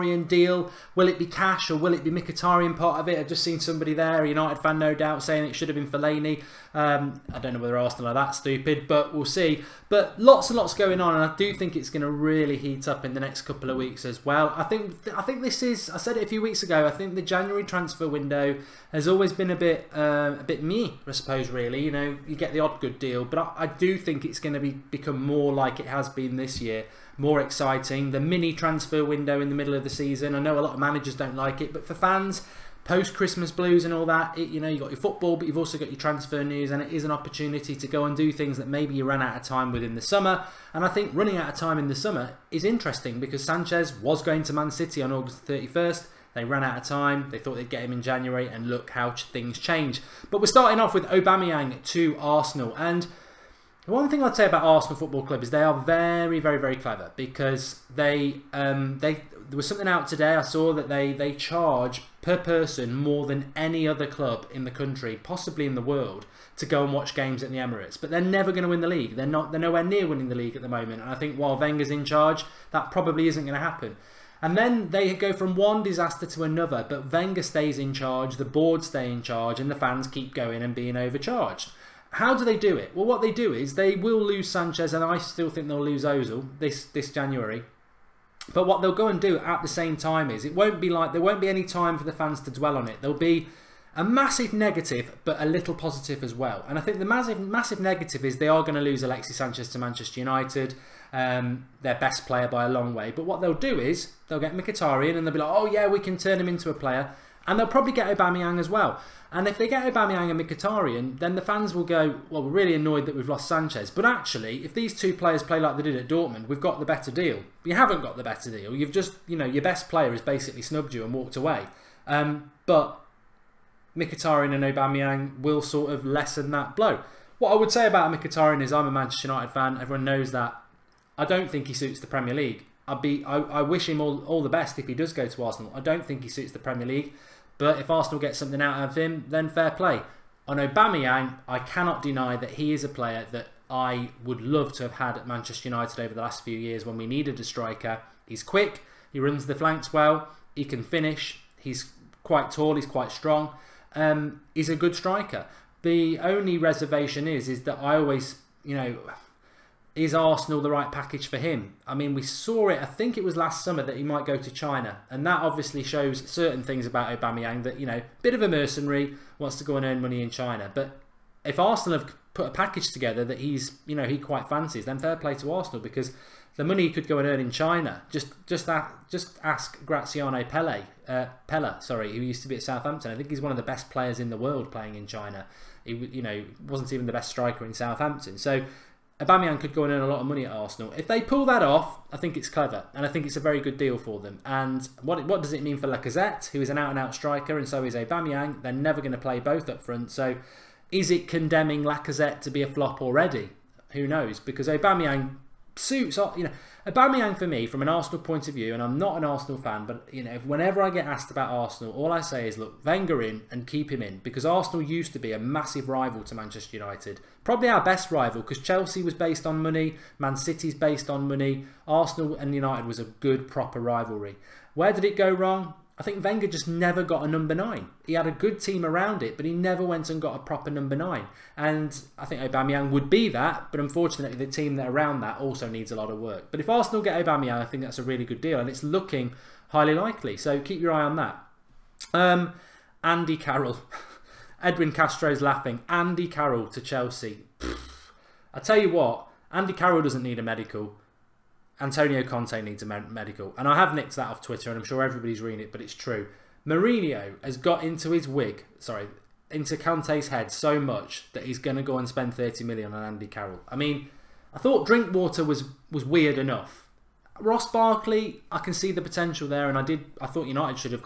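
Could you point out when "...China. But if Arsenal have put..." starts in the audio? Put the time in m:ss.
2:50.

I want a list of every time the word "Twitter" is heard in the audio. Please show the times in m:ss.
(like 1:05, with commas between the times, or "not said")
4:14.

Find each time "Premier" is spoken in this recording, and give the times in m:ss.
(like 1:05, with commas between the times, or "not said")
2:12, 2:16.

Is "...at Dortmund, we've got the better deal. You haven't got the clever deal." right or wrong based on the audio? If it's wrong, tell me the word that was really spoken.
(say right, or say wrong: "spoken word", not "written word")
wrong: "better", not "clever".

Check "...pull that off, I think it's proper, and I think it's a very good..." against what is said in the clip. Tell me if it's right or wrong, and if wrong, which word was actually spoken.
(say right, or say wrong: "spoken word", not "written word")
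wrong: "clever", not "proper".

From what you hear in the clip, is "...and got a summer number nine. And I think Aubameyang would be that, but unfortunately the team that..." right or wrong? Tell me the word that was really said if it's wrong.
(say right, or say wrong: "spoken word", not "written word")
wrong: "proper", not "summer".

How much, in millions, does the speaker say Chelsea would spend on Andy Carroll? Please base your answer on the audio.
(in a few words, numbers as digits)
30 million.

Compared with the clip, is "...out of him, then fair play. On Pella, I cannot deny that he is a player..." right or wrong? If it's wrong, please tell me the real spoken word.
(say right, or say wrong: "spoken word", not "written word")
wrong: "Aubameyang", not "Pella".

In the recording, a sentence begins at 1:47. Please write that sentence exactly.
And they'll probably get Aubameyang as well.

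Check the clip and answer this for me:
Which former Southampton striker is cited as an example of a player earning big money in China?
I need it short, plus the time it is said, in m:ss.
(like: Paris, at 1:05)
Graziano Pelle, at 2:59.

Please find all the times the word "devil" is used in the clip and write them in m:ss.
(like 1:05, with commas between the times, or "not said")
not said.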